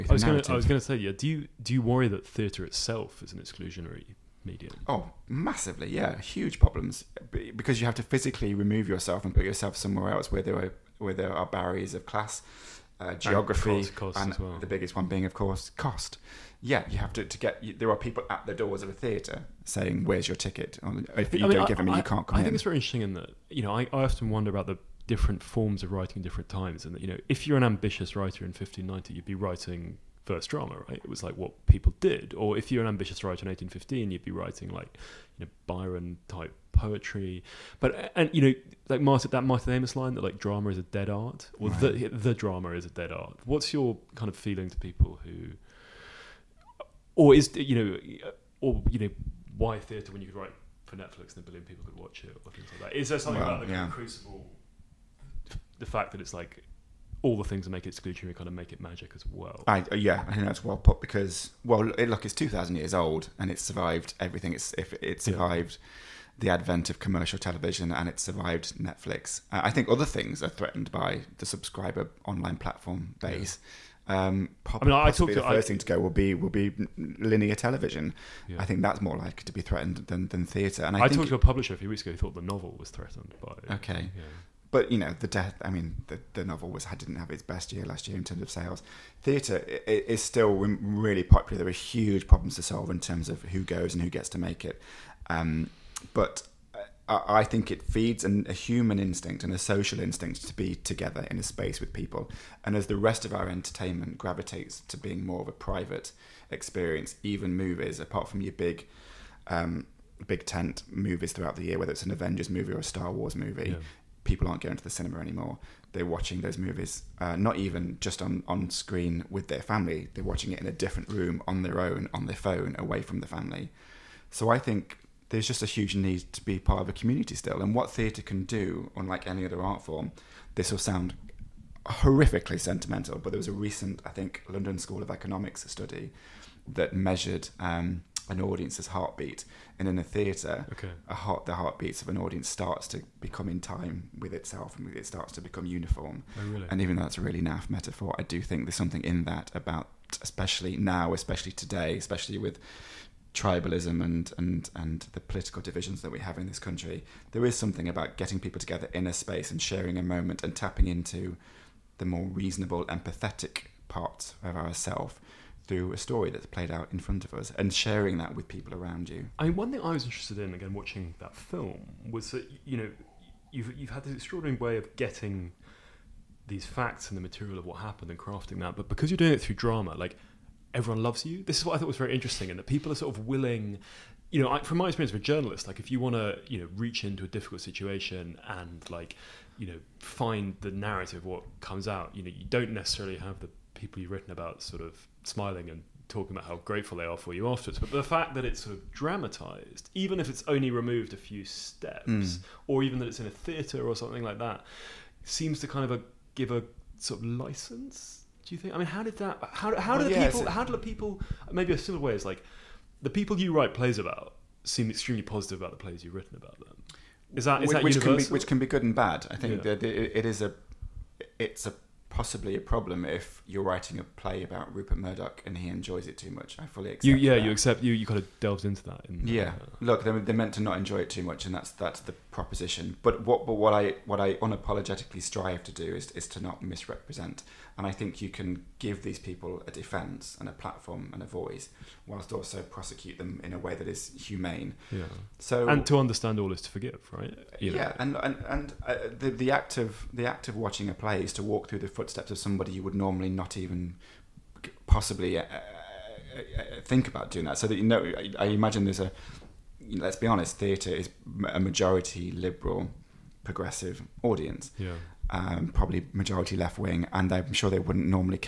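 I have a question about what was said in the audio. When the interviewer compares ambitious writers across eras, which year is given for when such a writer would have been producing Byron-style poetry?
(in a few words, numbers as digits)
1815.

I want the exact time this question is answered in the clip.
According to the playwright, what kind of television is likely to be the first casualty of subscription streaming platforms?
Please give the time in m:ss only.
1:16.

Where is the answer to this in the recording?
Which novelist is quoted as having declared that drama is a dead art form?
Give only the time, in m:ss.
0:39.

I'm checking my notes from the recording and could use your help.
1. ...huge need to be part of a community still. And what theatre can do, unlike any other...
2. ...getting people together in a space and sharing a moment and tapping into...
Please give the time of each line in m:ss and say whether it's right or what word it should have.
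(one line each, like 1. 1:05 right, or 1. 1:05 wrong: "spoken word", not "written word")
1. 2:05 right
2. 2:38 right.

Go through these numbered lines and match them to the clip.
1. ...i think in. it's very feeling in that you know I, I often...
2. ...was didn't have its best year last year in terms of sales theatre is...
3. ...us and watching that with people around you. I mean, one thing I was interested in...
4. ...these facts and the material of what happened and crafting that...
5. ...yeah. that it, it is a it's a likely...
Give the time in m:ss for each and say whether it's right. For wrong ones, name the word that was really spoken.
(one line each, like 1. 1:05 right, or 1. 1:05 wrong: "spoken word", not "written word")
1. 0:22 wrong: "interesting", not "feeling"
2. 1:26 right
3. 2:47 wrong: "sharing", not "watching"
4. 2:56 right
5. 3:39 wrong: "possibly", not "likely".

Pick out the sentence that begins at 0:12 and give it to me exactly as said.
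Uh, geography and, cost, cost and well.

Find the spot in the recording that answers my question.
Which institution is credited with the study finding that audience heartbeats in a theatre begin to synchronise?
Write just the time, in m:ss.
2:14.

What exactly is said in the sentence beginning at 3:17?
But the fact that it's sort of dramatized, even if it's only removed a few steps, mm.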